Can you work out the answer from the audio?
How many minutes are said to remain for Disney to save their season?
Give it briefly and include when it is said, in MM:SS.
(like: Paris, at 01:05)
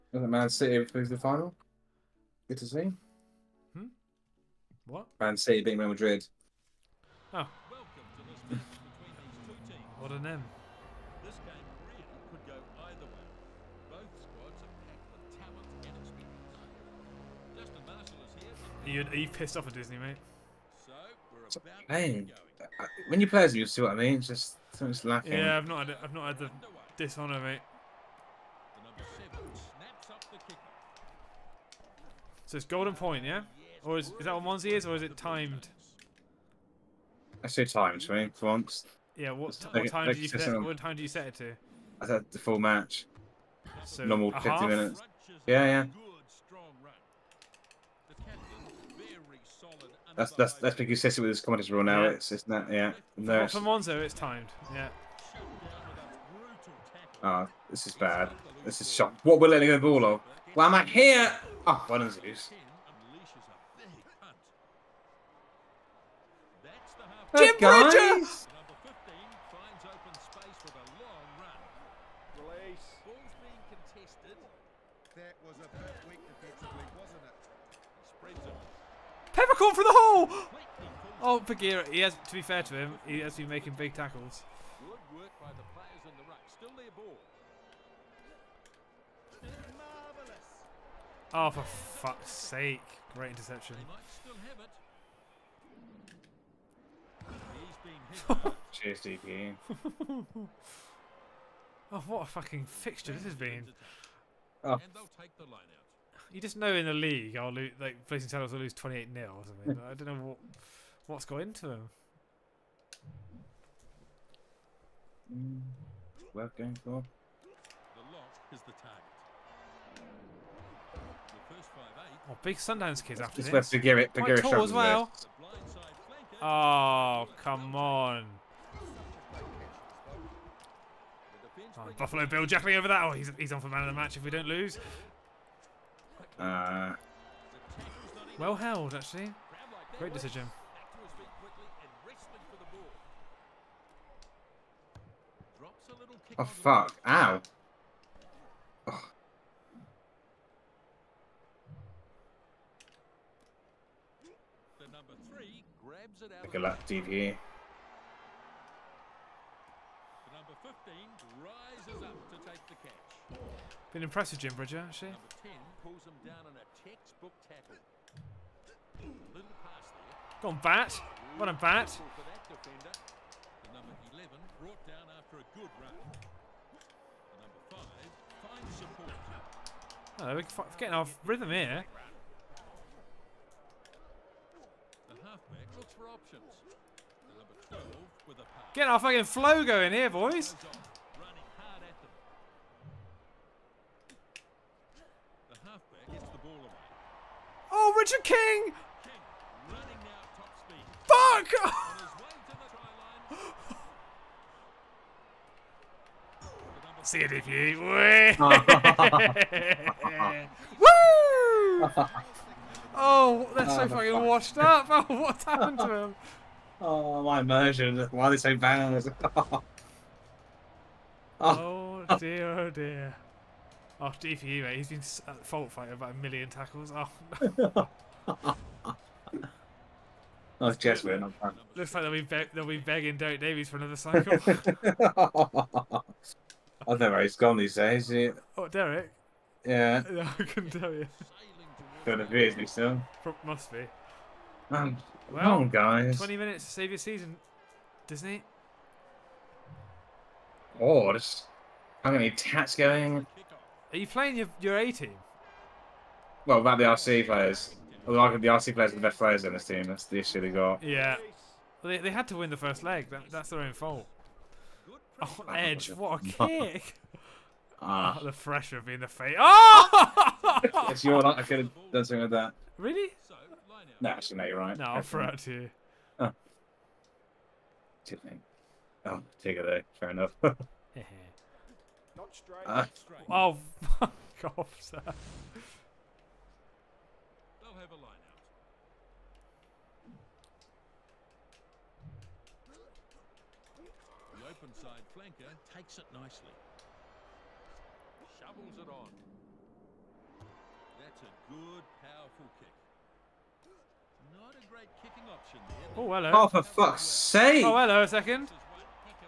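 20, at 04:06.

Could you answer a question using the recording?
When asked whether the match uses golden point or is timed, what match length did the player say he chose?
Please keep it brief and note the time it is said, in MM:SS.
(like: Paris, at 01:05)
The full match, at 00:42.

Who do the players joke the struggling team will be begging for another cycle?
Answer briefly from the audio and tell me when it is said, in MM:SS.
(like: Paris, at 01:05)
Derek Davies, at 03:53.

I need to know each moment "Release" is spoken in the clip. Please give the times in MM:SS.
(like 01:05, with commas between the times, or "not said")
01:12.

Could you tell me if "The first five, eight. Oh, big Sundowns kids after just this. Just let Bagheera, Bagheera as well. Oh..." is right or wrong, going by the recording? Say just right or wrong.
right.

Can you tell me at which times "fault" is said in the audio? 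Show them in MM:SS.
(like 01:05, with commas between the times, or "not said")
03:45, 04:23.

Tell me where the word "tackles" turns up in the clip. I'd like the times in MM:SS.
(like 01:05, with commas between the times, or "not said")
01:23, 03:46.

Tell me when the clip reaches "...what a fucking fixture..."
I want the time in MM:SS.
01:42.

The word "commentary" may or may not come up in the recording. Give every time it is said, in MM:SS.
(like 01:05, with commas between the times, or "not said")
00:51.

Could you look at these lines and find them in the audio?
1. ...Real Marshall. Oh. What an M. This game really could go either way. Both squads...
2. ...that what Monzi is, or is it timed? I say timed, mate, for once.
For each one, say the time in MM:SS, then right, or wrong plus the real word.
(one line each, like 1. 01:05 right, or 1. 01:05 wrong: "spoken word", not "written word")
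1. 00:05 wrong: "Madrid", not "Marshall"
2. 00:34 right.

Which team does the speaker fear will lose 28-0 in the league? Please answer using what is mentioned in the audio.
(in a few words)
Blazing Saddles.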